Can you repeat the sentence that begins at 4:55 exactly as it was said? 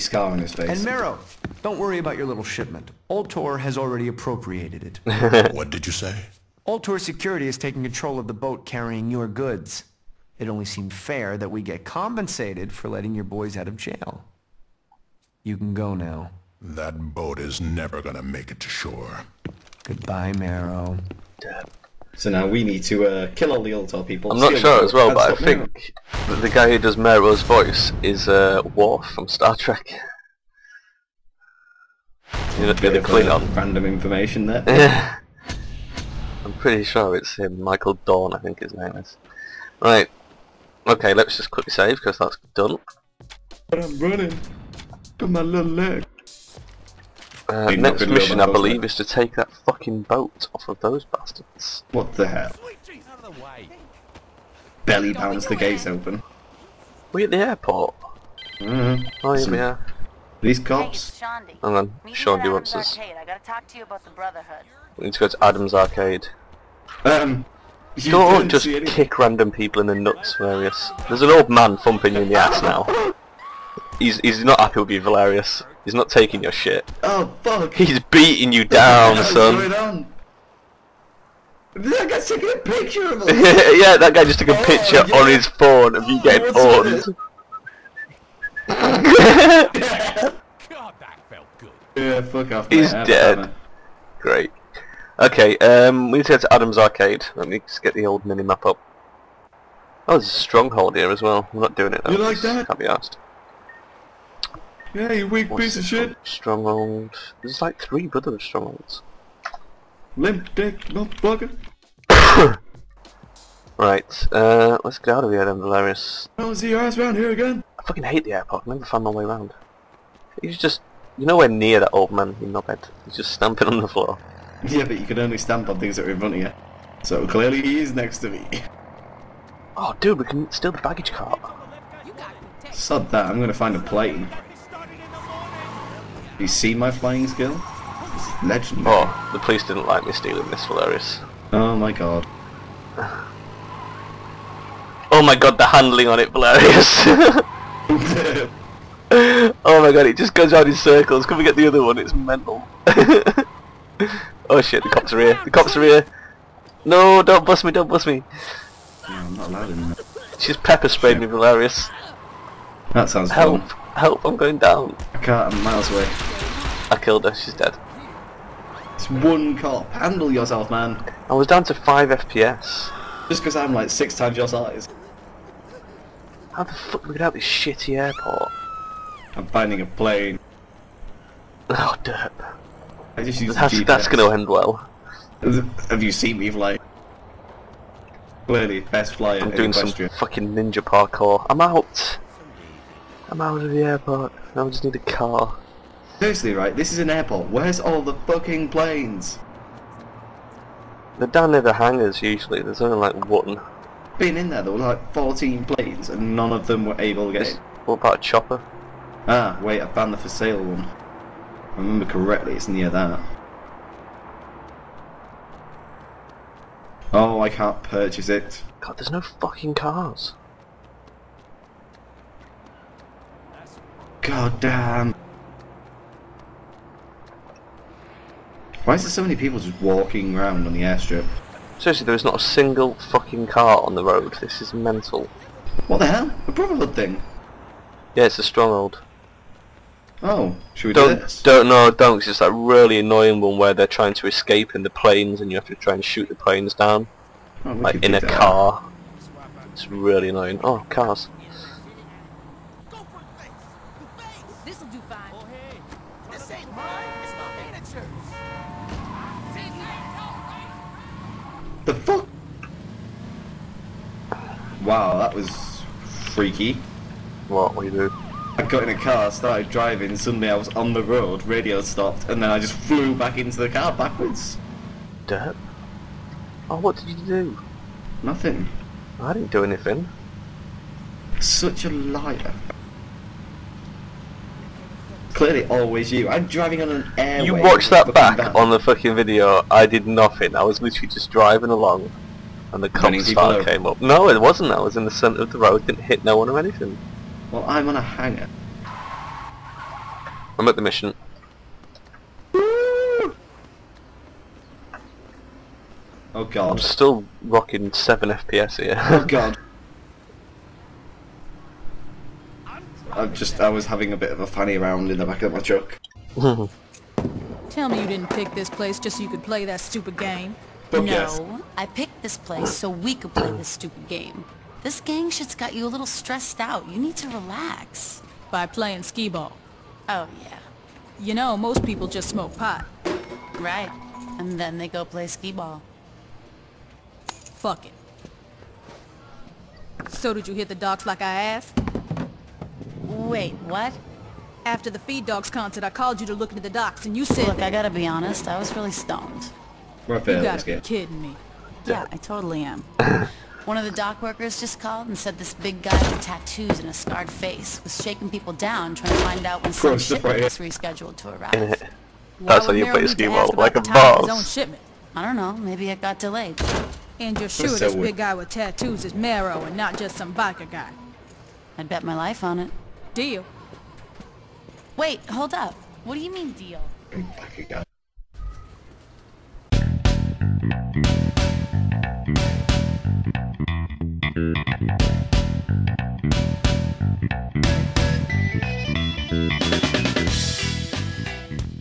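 Didn't hit no one or anything.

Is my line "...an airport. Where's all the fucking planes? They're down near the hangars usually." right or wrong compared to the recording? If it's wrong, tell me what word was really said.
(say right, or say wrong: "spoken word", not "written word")
right.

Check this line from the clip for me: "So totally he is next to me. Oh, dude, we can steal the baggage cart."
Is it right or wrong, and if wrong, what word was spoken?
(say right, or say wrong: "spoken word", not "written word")
wrong: "clearly", not "totally".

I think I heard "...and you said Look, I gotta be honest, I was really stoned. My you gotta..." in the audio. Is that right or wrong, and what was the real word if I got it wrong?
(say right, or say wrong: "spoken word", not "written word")
right.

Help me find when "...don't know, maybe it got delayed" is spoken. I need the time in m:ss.
6:05.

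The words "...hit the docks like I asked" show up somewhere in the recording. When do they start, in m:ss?
5:40.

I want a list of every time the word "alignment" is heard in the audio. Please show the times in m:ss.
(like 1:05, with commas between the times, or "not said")
not said.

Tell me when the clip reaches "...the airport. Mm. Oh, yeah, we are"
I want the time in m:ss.
0:57.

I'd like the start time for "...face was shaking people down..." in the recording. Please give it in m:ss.
5:57.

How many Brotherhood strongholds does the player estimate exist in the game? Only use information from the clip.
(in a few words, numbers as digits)
3.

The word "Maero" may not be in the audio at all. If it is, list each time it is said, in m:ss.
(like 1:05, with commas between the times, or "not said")
0:00, 0:20, 0:26, 6:09.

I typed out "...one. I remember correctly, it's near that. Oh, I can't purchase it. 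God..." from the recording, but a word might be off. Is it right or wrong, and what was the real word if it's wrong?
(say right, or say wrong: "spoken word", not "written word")
right.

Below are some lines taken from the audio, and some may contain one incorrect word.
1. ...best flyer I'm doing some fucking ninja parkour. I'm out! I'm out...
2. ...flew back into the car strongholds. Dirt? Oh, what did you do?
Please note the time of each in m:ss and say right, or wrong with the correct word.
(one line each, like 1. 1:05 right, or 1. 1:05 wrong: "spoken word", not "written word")
1. 3:08 right
2. 4:32 wrong: "backwards", not "strongholds".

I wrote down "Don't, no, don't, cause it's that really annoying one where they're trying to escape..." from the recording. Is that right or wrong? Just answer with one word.
right.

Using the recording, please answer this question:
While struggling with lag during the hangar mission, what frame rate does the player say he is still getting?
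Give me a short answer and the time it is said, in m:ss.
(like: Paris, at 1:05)
7 FPS, at 5:07.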